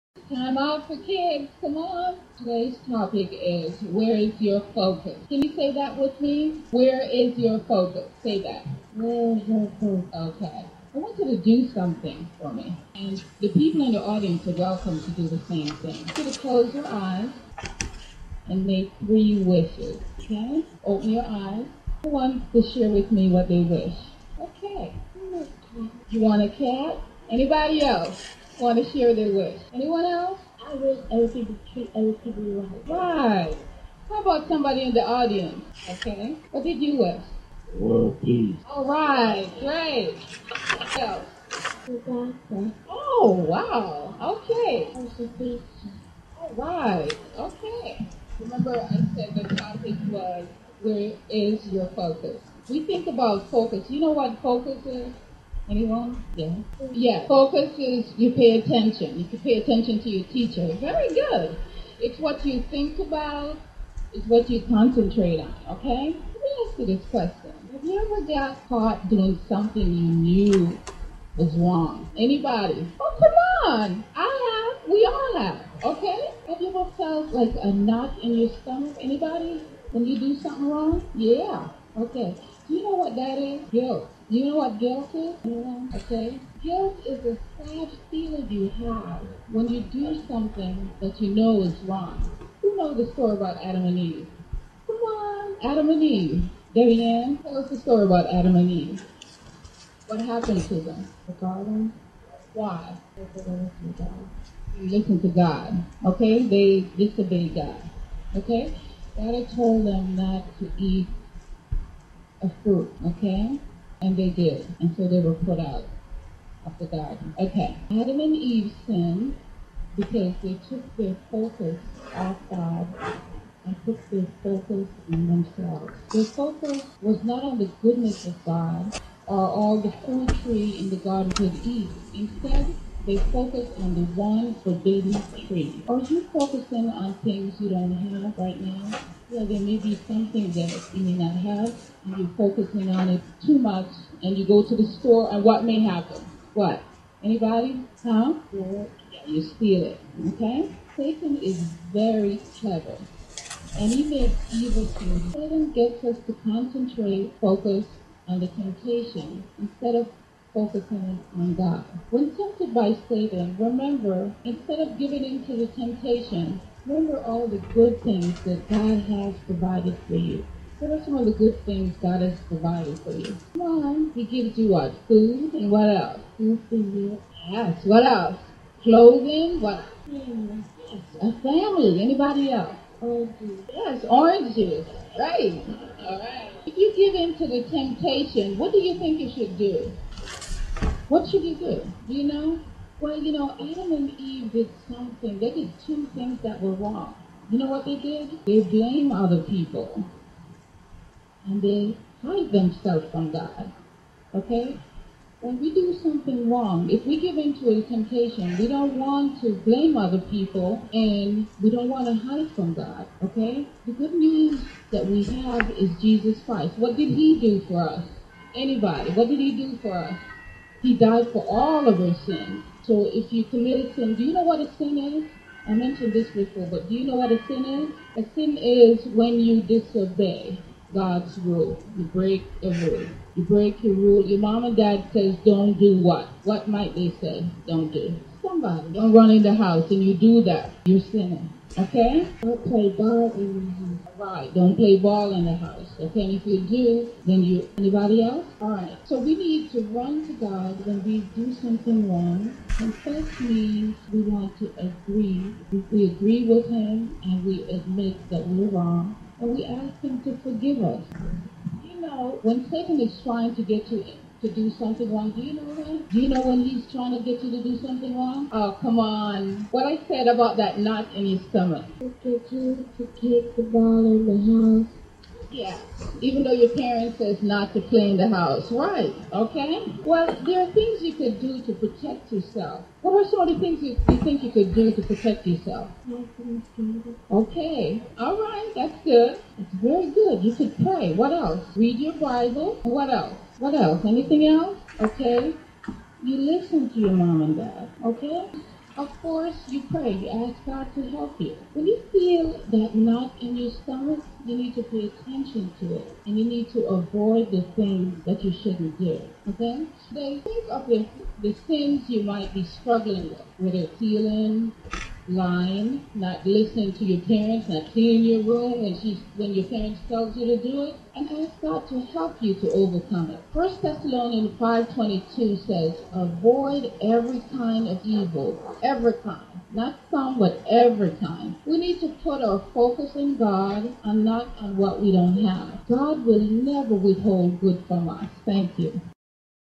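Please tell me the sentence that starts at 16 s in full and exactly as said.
to close your eyes and make three wishes.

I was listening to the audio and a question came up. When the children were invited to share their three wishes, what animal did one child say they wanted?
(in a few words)
A cat.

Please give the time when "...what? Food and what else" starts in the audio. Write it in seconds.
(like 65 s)
174 s.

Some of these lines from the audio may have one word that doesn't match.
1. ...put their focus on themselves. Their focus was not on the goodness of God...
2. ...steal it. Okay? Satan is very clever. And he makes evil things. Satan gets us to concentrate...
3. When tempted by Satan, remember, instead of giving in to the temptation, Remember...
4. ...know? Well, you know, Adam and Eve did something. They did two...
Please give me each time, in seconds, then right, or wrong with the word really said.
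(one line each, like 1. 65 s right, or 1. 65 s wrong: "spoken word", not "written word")
1. 123 s right
2. 149 s right
3. 162 s right
4. 192 s right.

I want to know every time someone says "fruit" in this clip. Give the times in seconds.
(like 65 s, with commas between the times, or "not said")
112 s, 130 s.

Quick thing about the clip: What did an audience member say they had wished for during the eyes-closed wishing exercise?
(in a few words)
World peace.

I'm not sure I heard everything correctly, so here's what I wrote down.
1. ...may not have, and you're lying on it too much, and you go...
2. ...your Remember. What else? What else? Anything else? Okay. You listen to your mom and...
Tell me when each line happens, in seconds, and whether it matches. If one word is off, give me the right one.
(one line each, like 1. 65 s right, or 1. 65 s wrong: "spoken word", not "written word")
1. 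141 s wrong: "focusing", not "lying"
2. 291 s wrong: "Bible", not "Remember".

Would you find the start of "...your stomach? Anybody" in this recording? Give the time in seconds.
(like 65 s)
78 s.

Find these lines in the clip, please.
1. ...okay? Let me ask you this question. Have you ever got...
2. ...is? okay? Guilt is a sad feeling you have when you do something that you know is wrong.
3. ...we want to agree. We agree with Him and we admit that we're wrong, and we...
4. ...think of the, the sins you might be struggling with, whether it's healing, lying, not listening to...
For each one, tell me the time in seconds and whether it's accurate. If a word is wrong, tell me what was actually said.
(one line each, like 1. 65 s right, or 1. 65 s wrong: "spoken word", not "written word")
1. 65 s right
2. 85 s right
3. 254 s right
4. 310 s right.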